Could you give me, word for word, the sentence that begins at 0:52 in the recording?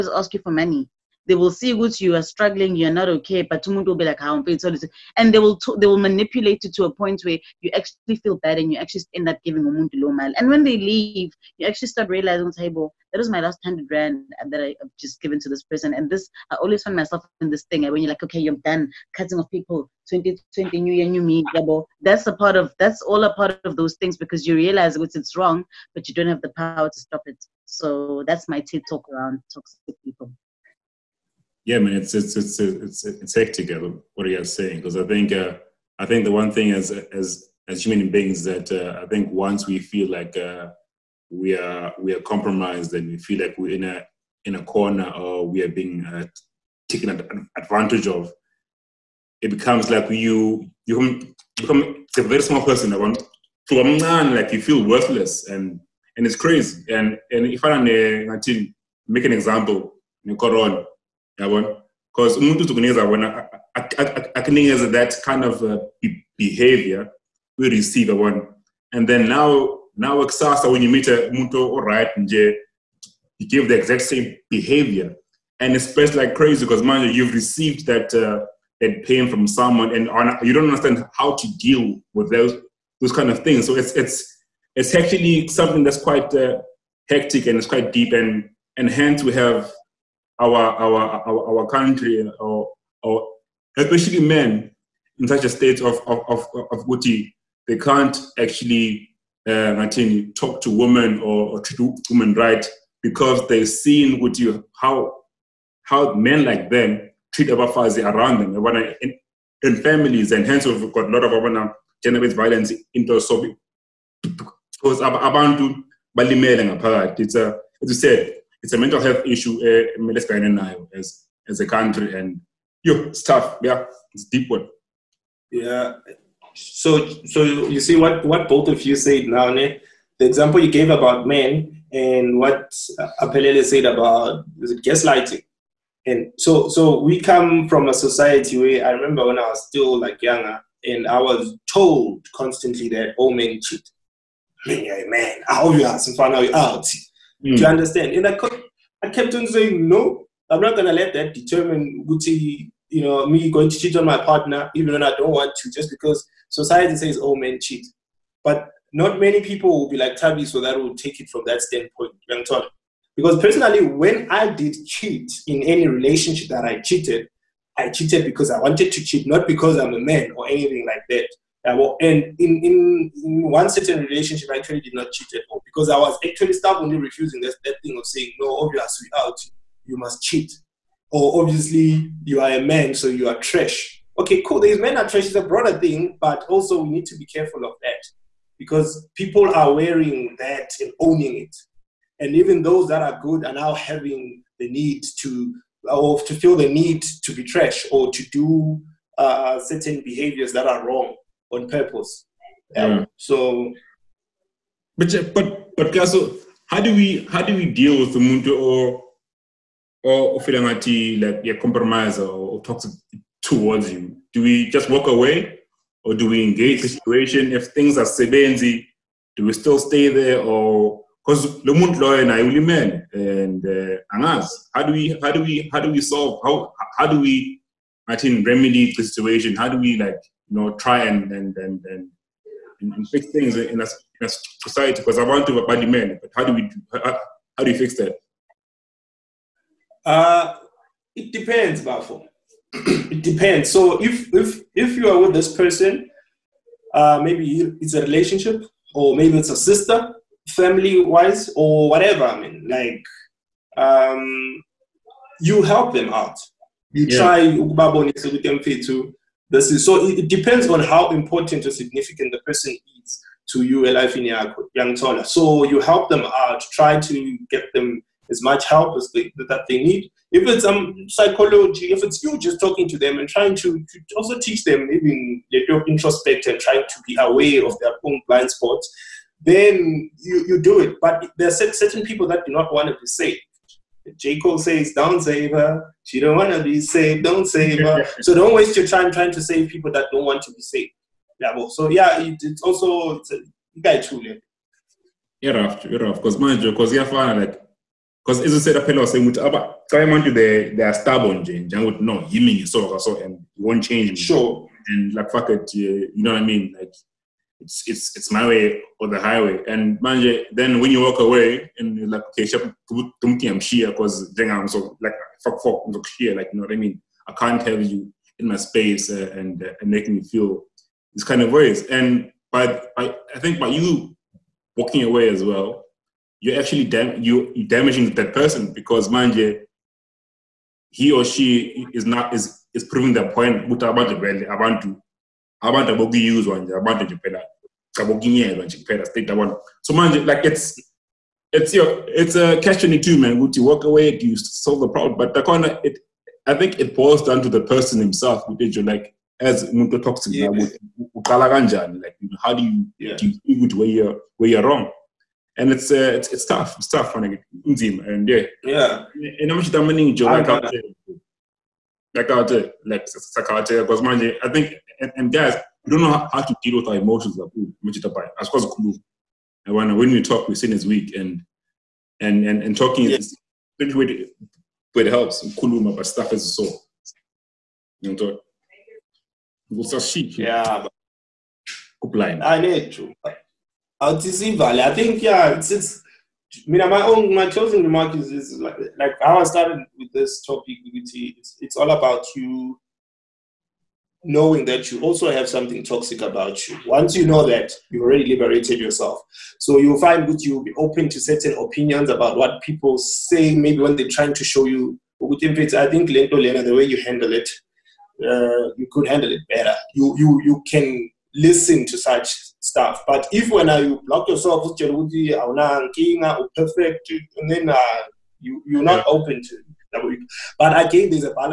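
Like you feel worthless and and it's crazy.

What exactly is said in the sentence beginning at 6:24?
I think yeah, it's, it's I mean, my own my closing remark is, is like, like, how I started with this topic.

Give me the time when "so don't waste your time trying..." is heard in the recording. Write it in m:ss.
4:48.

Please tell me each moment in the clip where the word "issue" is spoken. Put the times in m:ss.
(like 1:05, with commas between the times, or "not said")
1:59.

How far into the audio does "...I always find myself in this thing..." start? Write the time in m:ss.
0:16.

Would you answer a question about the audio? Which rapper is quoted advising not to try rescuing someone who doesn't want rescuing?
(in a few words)
J. Cole.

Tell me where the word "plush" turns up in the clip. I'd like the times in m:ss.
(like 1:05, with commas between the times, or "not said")
not said.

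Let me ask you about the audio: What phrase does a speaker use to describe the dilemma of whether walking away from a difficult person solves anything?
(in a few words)
catch 22.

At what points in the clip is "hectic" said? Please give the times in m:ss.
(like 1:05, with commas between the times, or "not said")
0:33, 1:27.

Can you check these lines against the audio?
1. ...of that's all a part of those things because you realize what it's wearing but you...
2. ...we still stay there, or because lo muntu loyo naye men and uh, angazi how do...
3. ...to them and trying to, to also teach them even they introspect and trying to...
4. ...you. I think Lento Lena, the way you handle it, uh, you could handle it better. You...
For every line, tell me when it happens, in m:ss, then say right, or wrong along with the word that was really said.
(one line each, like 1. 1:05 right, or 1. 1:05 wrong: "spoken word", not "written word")
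1. 0:22 wrong: "wrong", not "wearing"
2. 3:39 right
3. 4:32 right
4. 6:44 right.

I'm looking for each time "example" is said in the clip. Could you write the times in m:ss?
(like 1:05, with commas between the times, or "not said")
0:59, 2:10.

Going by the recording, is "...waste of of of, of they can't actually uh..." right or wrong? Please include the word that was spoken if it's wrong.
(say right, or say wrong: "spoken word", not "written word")
wrong: "state", not "waste".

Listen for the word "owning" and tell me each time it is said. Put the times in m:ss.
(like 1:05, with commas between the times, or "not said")
3:10.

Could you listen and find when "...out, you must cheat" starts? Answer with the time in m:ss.
2:59.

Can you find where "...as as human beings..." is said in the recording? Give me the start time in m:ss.
0:36.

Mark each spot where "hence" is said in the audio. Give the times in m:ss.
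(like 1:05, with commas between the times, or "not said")
1:28, 1:50.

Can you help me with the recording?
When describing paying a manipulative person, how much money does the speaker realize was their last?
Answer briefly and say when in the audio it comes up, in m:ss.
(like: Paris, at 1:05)
100 rand, at 0:13.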